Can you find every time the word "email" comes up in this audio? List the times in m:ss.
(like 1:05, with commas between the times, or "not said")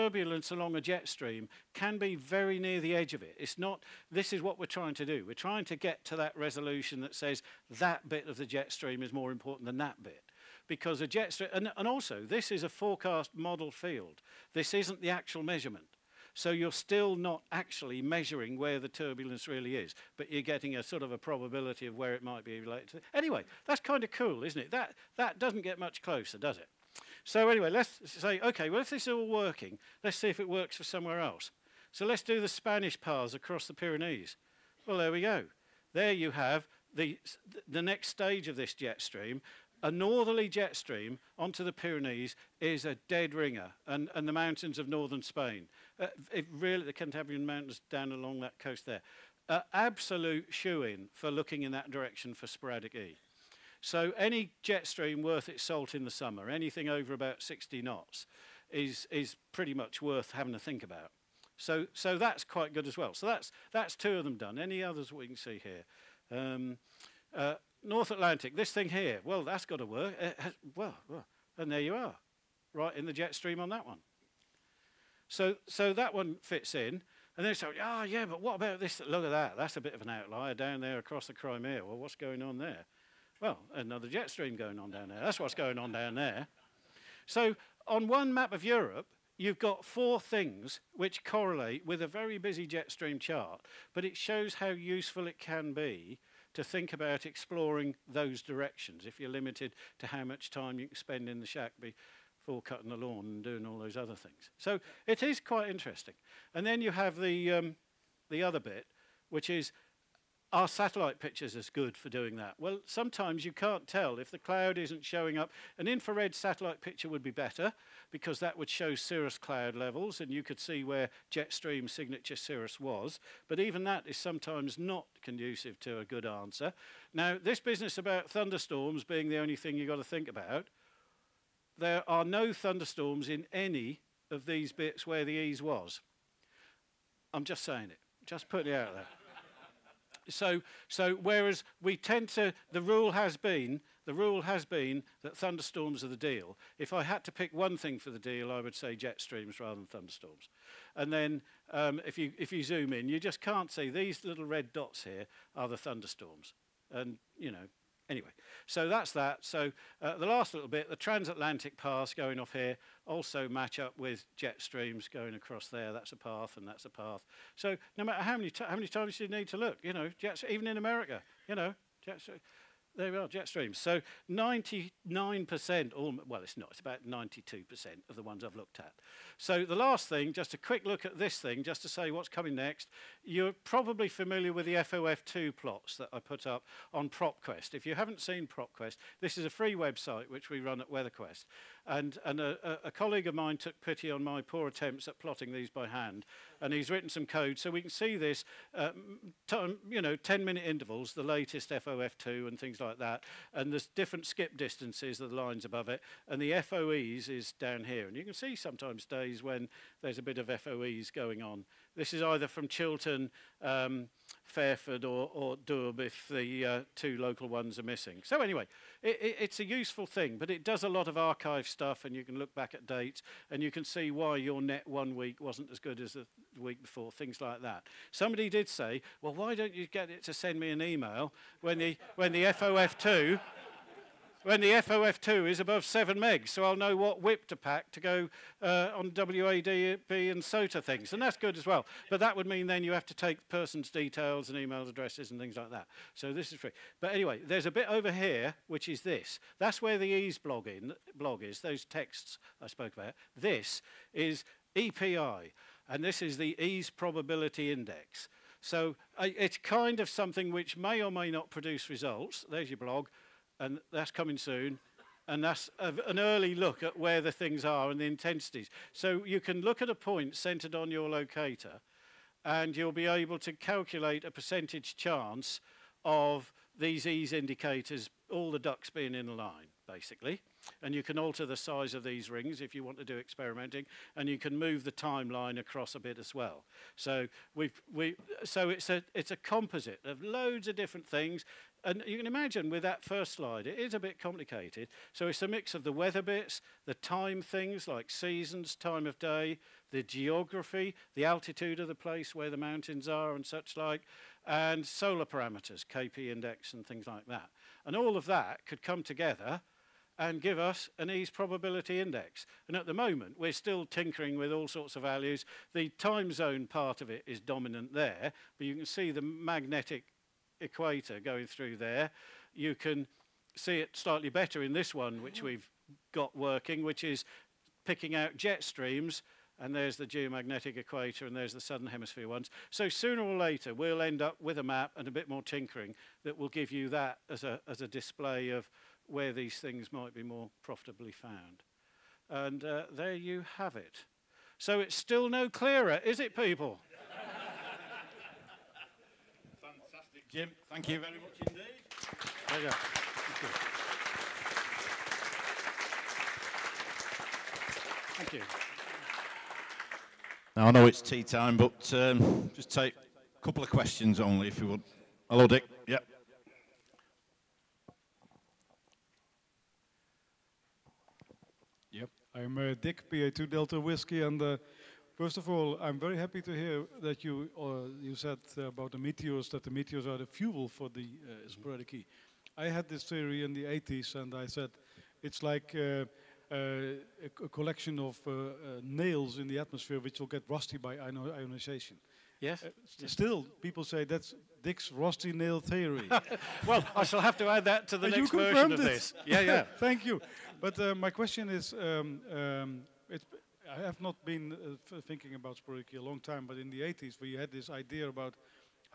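3:50, 4:04.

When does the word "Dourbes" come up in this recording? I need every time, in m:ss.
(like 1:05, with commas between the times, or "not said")
3:35.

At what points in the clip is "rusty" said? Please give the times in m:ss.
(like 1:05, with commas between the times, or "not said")
6:30, 6:34.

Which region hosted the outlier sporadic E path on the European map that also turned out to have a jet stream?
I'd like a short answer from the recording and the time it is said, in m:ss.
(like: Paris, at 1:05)
Crimea, at 1:21.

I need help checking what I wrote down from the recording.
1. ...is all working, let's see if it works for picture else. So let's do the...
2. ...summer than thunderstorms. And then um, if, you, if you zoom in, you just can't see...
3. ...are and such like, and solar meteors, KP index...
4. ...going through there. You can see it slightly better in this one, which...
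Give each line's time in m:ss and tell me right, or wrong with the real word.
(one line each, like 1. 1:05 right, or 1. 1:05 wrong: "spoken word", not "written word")
1. 0:29 wrong: "somewhere", not "picture"
2. 2:29 wrong: "rather", not "summer"
3. 5:03 wrong: "parameters", not "meteors"
4. 5:21 right.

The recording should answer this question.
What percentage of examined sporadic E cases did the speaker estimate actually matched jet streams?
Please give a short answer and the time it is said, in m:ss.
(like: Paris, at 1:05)
92%, at 2:57.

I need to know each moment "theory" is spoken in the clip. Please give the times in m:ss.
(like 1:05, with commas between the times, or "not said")
6:23, 6:35.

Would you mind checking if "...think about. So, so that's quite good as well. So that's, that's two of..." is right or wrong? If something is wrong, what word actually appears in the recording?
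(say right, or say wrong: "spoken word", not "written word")
right.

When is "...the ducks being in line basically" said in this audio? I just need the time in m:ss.
4:38.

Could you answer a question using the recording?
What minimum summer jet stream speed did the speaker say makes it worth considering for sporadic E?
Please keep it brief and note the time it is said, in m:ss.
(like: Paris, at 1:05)
60 knots, at 0:57.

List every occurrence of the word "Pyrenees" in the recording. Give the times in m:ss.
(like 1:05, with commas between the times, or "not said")
0:33, 0:41.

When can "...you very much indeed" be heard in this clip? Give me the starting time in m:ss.
5:50.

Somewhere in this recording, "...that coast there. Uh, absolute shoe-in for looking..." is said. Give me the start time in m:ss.
0:48.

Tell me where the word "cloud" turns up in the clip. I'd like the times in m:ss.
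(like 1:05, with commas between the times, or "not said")
1:54, 1:59.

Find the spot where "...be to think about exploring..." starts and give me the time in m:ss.
1:35.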